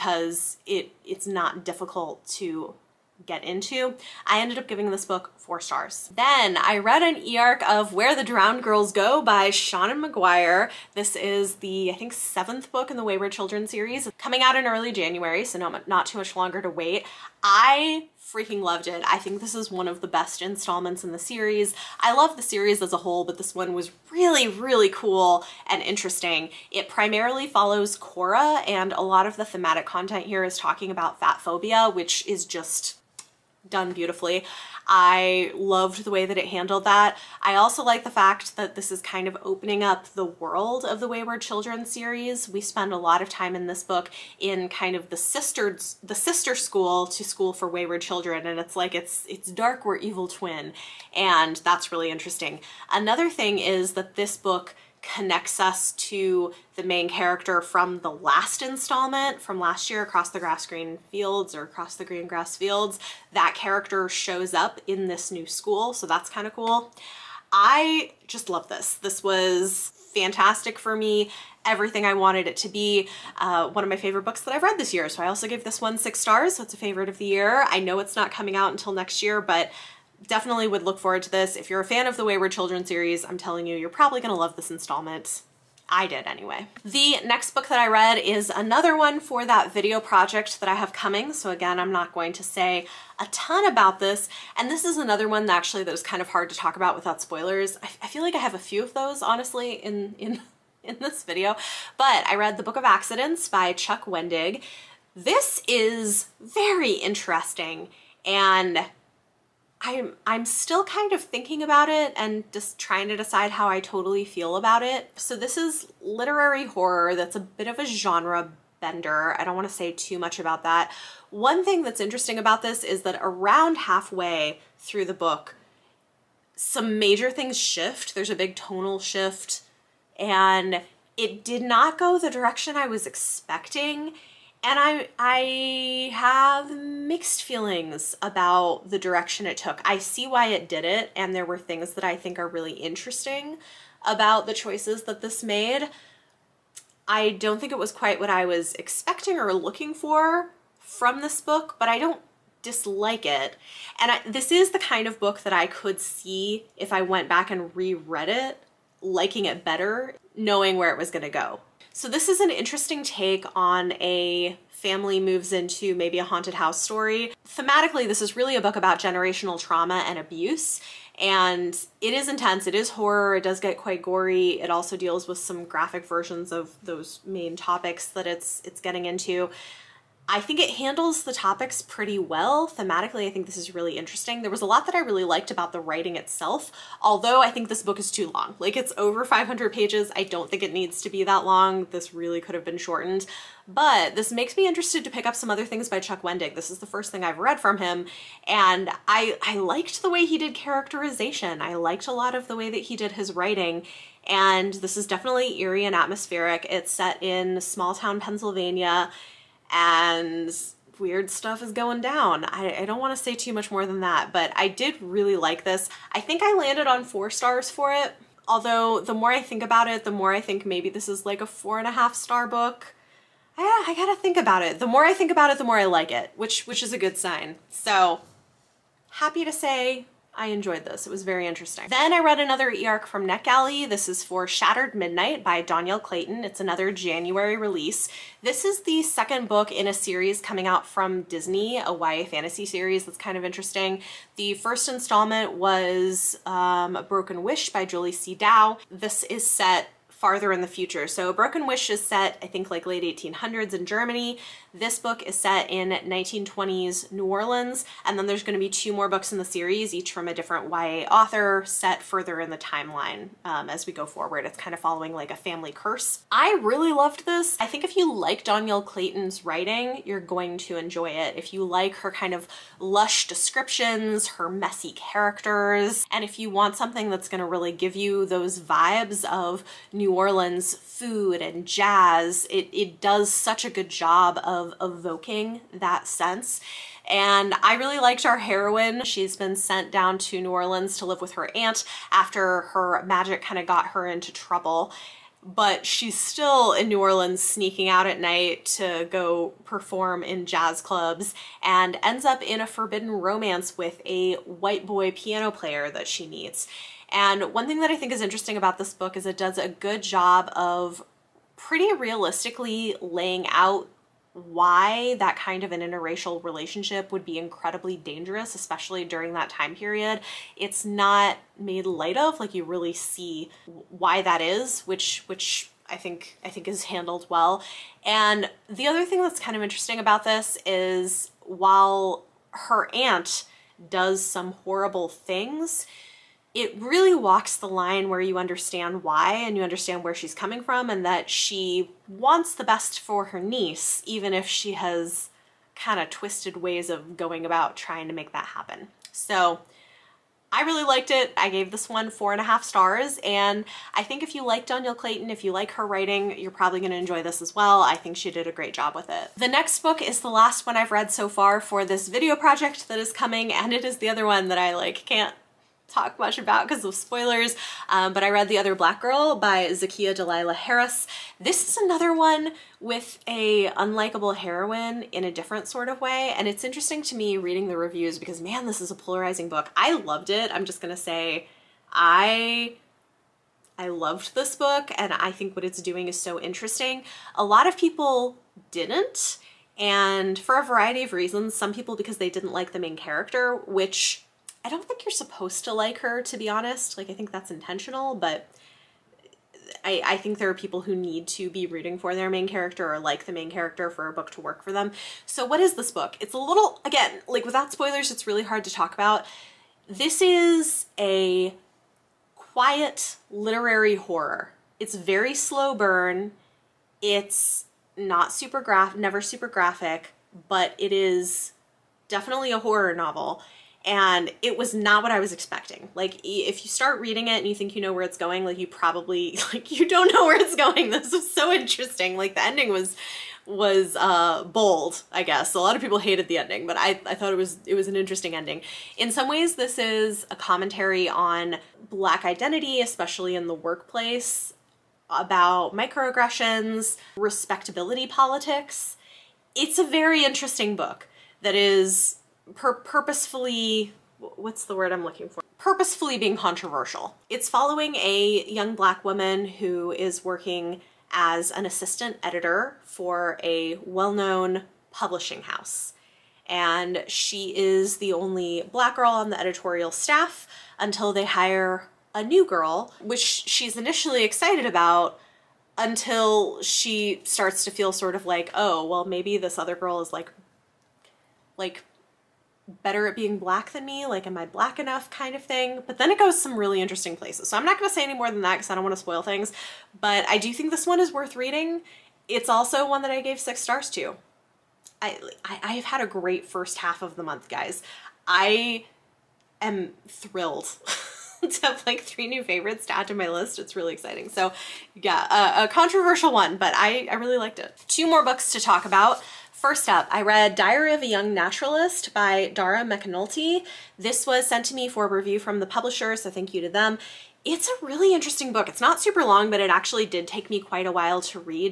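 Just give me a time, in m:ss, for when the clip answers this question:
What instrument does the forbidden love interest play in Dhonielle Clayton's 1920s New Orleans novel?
5:05.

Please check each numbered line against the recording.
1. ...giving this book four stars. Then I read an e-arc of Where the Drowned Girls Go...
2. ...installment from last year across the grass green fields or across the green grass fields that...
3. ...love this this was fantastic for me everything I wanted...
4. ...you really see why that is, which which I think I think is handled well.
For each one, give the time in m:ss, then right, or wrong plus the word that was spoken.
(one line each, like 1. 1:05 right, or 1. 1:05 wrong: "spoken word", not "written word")
1. 0:04 right
2. 0:58 right
3. 1:08 right
4. 5:22 right.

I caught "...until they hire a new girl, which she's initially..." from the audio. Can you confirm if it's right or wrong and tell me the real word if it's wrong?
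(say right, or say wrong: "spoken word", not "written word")
right.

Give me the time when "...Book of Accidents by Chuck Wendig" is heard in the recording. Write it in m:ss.
1:42.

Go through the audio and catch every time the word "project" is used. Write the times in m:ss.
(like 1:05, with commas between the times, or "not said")
1:29, 6:02.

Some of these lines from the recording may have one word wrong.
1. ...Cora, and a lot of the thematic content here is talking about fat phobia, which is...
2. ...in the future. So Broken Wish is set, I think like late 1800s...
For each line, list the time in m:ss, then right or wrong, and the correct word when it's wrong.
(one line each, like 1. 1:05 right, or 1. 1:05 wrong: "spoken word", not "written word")
1. 0:27 right
2. 4:10 right.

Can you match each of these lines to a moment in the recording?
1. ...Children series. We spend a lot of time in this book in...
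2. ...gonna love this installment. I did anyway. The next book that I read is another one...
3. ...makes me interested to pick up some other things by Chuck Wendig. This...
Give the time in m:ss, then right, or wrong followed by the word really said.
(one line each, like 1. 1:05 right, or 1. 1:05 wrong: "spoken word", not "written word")
1. 0:41 right
2. 1:24 right
3. 3:14 right.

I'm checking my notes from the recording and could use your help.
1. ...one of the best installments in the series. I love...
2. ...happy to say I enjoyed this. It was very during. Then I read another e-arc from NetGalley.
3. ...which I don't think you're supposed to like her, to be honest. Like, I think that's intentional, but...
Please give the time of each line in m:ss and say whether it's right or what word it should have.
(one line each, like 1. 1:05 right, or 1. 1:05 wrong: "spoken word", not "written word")
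1. 0:19 right
2. 3:49 wrong: "interesting", not "during"
3. 6:33 right.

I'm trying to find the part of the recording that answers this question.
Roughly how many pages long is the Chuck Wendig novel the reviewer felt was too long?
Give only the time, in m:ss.
3:08.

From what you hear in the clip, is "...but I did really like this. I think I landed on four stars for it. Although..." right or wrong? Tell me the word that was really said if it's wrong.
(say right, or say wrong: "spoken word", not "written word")
right.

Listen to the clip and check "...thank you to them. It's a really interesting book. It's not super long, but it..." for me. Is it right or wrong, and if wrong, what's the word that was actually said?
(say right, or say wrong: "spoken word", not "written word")
right.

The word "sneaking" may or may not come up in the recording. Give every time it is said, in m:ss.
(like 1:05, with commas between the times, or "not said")
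4:57.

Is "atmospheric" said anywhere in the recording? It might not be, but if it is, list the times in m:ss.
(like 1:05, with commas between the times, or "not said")
3:25.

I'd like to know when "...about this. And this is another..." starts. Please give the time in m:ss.
1:33.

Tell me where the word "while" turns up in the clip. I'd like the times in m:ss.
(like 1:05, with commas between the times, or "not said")
5:31, 8:40.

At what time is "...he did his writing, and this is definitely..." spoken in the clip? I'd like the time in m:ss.
3:22.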